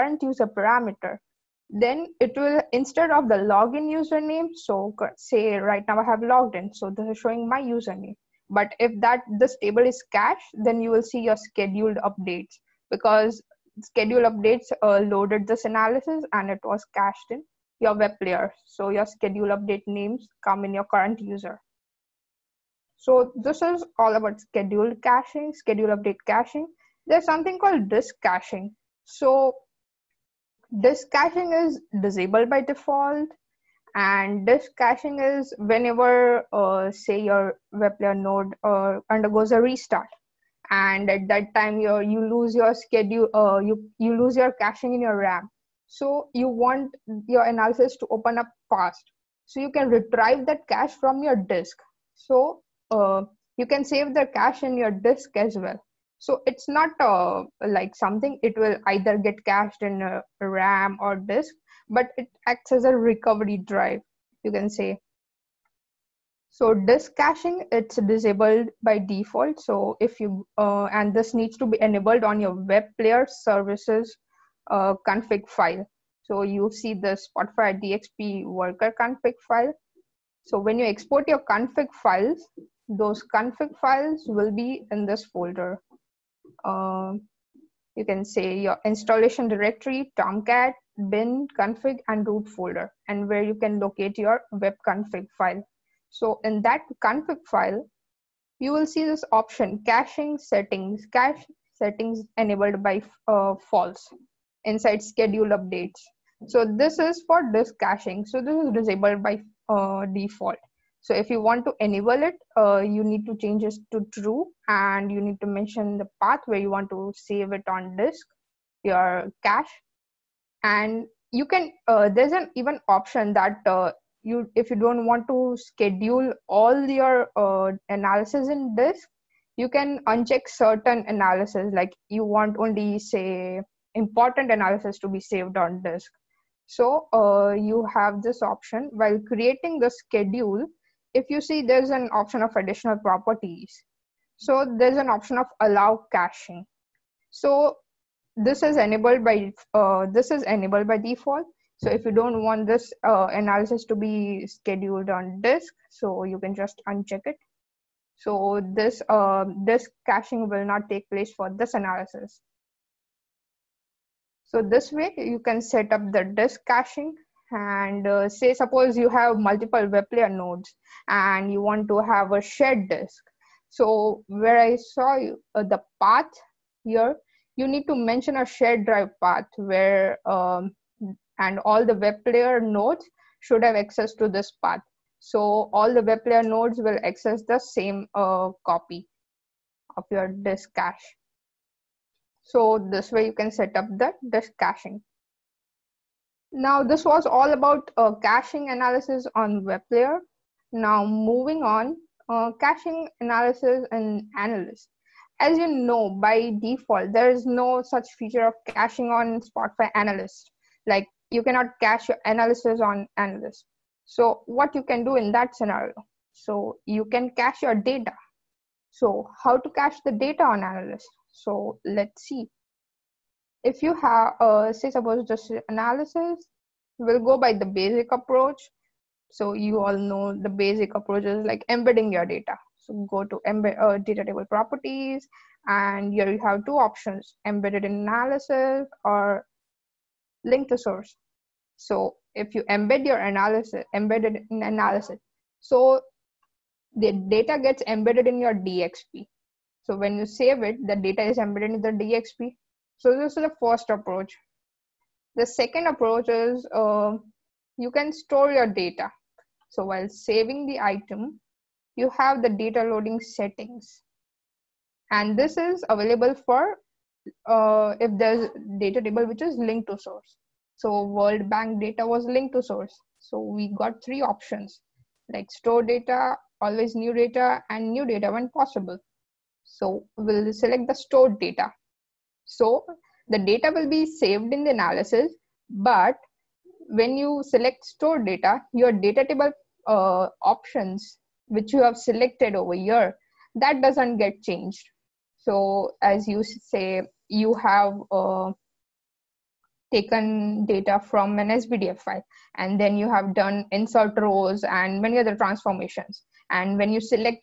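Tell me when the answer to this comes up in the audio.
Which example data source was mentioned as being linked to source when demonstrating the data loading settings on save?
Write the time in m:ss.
4:31.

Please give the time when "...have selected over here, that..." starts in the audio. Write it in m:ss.
4:51.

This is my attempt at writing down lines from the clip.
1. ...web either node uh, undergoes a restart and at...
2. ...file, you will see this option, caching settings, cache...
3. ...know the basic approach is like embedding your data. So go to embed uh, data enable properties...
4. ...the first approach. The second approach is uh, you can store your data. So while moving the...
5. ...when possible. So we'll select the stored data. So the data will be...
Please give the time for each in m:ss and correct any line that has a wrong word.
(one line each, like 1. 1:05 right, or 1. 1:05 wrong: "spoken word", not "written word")
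1. 0:37 wrong: "player", not "either"
2. 1:37 right
3. 3:49 wrong: "table", not "enable"
4. 4:13 wrong: "saving", not "moving"
5. 4:38 right.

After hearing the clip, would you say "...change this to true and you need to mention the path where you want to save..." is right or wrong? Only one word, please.
right.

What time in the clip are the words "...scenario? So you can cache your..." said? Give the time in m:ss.
3:35.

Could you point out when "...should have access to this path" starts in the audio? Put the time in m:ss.
3:03.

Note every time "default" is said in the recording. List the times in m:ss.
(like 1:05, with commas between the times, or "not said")
0:32, 1:08, 1:50, 2:30, 3:26.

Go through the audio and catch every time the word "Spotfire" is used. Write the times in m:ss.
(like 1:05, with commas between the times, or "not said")
1:17, 3:29.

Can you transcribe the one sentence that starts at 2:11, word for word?
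Like you want only say important analysis to be saved on disk.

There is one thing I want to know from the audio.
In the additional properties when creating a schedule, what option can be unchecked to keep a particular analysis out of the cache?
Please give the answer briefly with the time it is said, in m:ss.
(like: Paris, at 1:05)
Allow caching, at 2:25.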